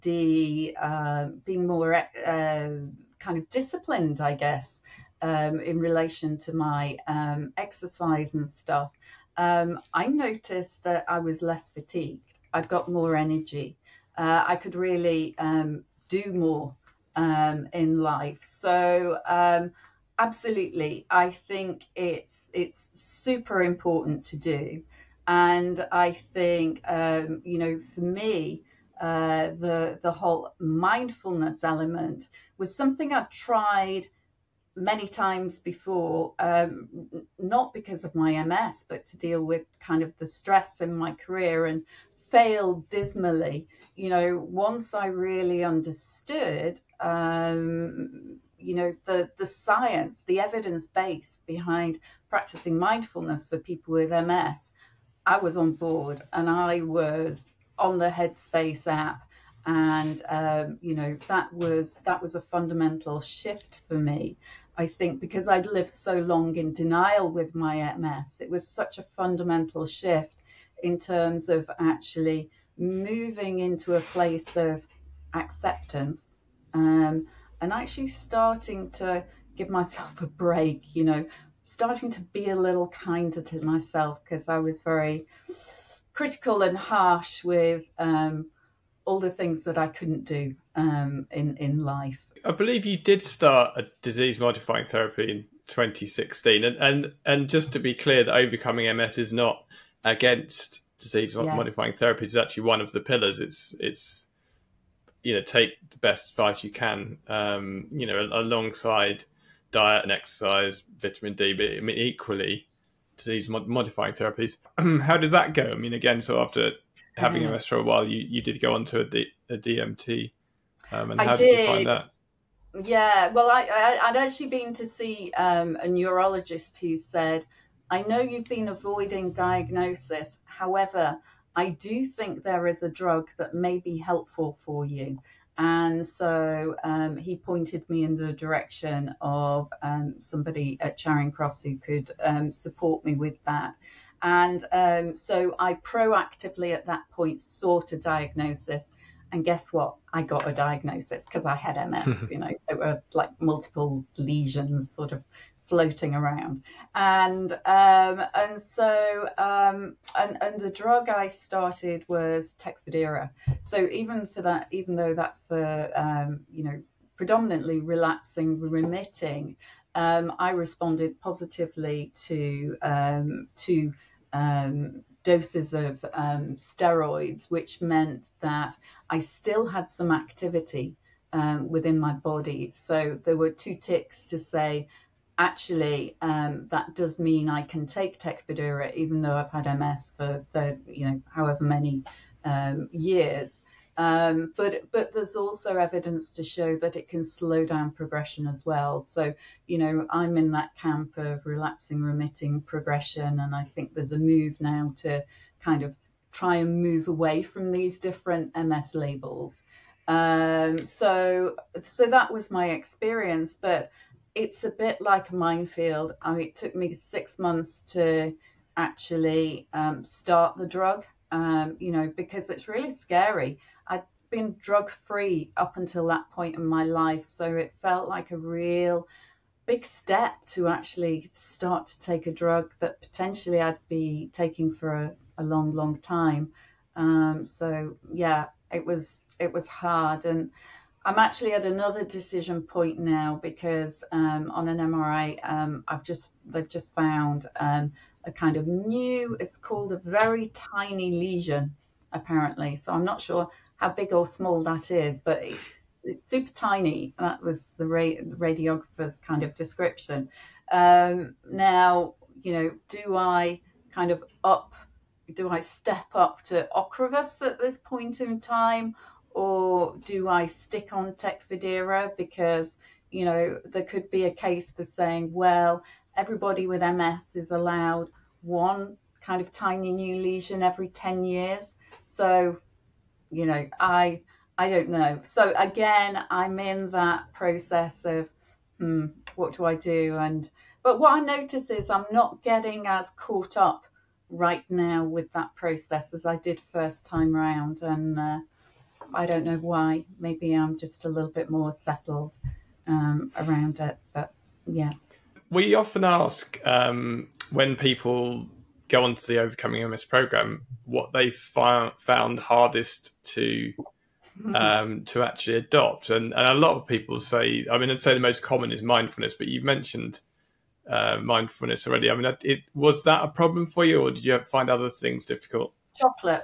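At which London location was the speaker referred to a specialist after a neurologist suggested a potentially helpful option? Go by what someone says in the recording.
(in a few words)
Charing Cross.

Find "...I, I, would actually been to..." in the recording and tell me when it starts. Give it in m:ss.
2:03.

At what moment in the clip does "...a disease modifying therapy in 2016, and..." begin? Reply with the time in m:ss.
1:33.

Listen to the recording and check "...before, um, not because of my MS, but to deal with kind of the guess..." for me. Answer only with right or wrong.
wrong.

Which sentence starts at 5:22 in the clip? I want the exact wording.
I mean, uh, it was that a problem for you, or did you find other things difficult?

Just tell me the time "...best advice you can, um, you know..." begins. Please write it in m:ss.
1:45.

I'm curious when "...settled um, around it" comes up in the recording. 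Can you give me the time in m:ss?
5:01.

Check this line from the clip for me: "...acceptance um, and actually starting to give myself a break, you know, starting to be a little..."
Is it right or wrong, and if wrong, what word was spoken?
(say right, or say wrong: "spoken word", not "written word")
right.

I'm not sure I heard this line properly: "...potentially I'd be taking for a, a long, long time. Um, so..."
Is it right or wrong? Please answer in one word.
right.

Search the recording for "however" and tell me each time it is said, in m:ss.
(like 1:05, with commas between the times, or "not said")
2:10, 3:11.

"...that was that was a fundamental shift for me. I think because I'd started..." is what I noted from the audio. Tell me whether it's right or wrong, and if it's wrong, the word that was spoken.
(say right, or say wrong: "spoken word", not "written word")
wrong: "lived", not "started".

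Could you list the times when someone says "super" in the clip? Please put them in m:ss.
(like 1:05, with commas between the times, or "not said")
0:22, 4:16.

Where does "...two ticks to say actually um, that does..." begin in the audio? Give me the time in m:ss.
3:03.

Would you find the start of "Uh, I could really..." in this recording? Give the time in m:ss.
0:14.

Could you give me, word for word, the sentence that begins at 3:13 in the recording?
Um, but but there's also evidence to show that it can slow down progression as well.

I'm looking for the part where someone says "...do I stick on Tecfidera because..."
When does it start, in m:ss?
4:30.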